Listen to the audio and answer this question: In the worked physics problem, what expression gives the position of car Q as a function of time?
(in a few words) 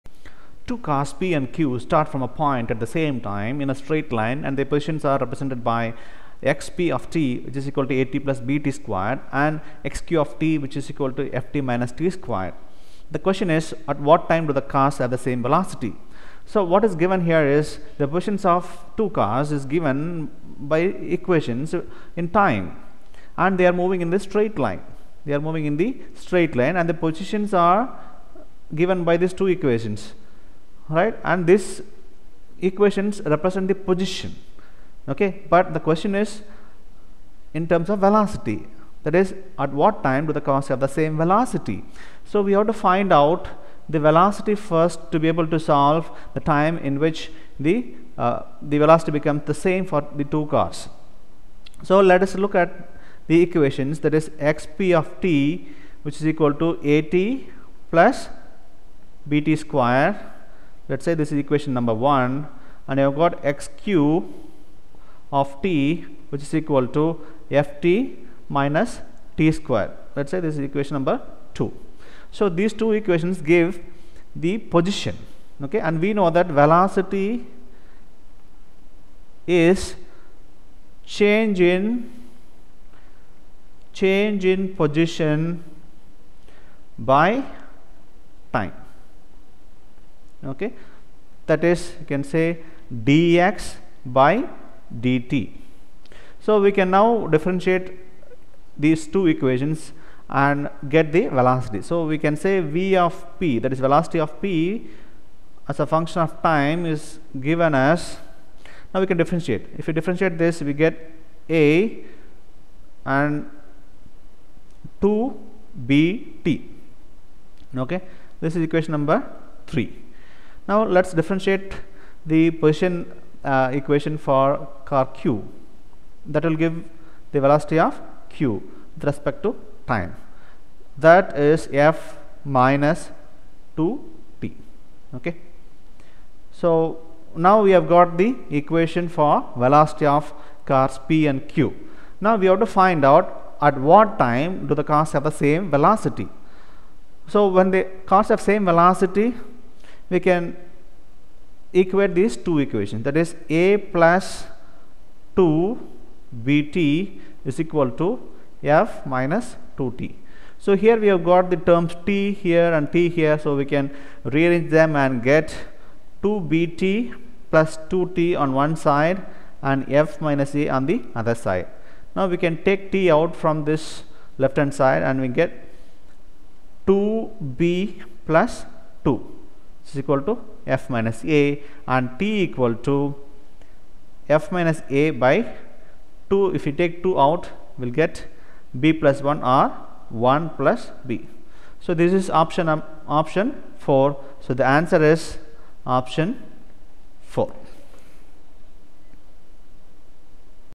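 ft - t².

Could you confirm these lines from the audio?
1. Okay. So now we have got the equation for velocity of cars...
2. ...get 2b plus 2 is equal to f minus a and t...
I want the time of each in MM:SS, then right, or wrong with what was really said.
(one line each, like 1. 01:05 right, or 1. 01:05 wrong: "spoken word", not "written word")
1. 02:15 right
2. 02:55 right.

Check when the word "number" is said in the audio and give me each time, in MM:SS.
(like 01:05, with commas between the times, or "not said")
01:01, 01:10, 01:58.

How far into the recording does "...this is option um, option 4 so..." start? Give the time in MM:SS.
03:12.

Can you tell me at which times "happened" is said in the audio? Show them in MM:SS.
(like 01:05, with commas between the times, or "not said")
not said.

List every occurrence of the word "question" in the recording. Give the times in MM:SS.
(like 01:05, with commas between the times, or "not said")
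00:13, 00:35.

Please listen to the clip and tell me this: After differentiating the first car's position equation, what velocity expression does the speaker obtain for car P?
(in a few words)
a + 2bt.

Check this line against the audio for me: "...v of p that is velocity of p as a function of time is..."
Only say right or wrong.
right.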